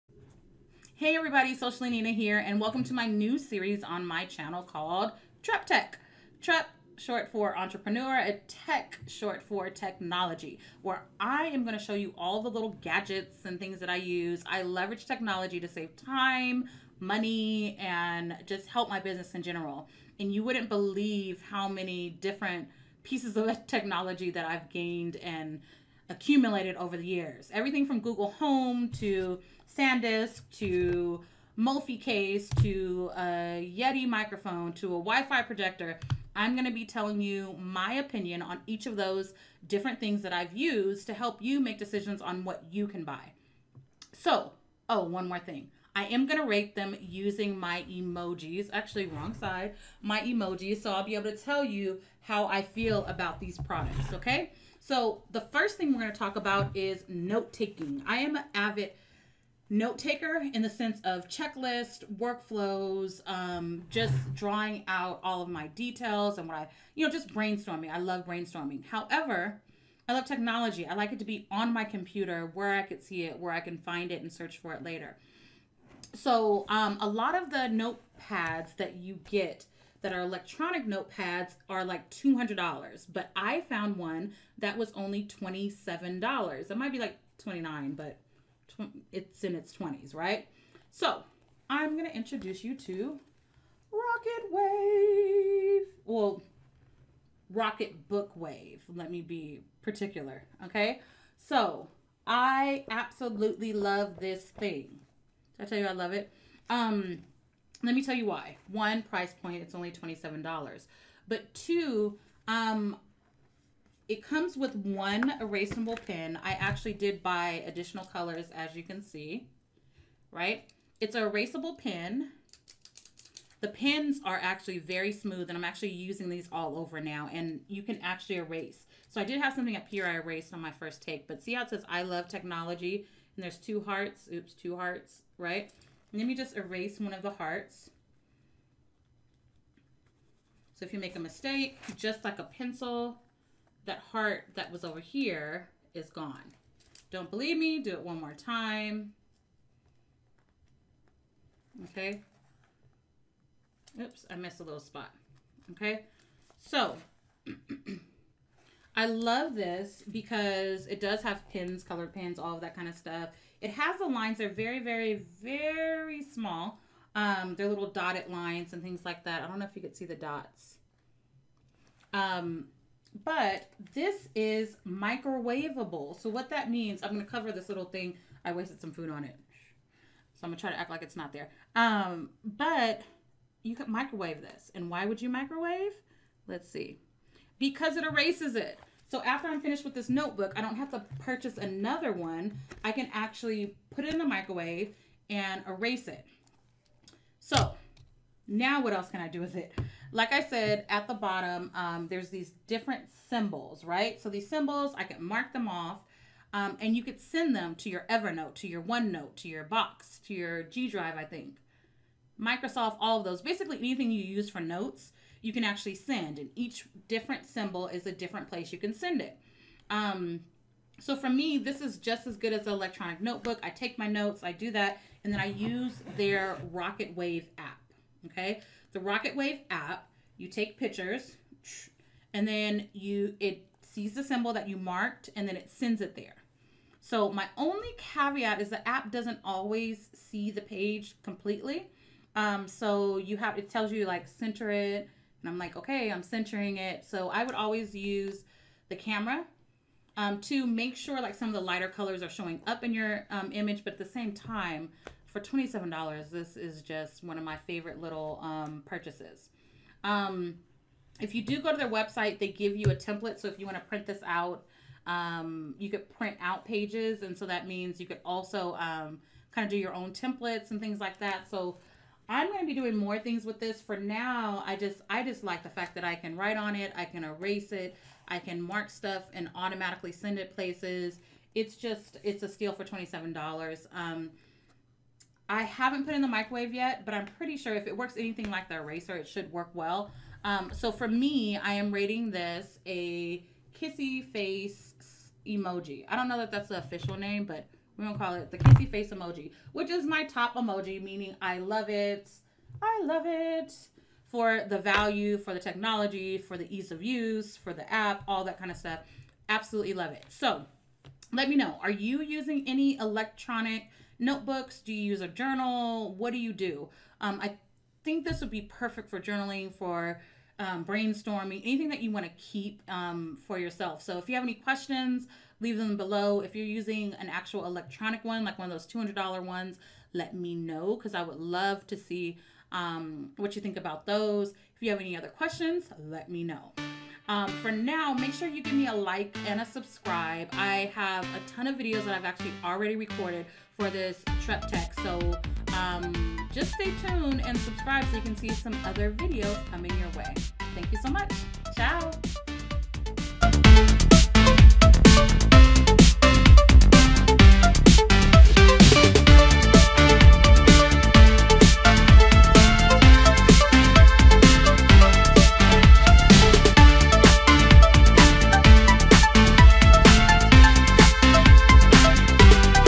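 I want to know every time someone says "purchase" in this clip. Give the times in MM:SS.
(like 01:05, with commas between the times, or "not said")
03:11, 04:18.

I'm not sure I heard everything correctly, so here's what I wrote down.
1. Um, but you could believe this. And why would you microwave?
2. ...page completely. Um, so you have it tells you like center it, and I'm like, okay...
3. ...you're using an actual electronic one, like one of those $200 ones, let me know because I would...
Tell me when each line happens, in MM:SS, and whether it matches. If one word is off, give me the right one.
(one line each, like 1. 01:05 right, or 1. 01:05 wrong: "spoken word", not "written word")
1. 03:01 wrong: "microwave", not "believe"
2. 04:00 right
3. 05:26 right.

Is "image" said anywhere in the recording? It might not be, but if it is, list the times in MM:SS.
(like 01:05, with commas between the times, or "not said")
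04:13.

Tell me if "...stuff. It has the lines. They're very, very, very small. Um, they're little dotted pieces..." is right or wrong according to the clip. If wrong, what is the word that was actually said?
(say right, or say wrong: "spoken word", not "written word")
wrong: "lines", not "pieces".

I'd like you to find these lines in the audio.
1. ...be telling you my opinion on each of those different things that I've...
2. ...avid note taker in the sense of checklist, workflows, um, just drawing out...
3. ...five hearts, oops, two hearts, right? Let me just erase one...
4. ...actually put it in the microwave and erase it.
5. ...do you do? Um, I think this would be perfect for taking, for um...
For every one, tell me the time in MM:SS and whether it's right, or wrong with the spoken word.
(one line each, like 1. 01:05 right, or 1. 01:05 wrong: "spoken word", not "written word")
1. 00:36 right
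2. 00:58 right
3. 02:13 wrong: "two", not "five"
4. 03:13 right
5. 05:16 wrong: "journaling", not "taking".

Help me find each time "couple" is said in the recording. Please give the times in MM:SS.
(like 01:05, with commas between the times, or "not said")
not said.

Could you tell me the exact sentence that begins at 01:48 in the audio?
One, price point, it's only $27.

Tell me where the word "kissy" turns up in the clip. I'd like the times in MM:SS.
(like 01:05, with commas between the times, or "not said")
04:53, 04:58.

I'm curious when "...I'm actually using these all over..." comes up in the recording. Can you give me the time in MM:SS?
02:05.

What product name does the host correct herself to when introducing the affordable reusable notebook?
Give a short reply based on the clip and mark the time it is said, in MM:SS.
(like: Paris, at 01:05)
Rocket Book Wave, at 01:37.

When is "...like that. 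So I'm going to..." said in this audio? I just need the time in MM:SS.
04:30.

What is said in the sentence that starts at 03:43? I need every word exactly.
I take my notes, I do that, and then I use their Rocket Wave app.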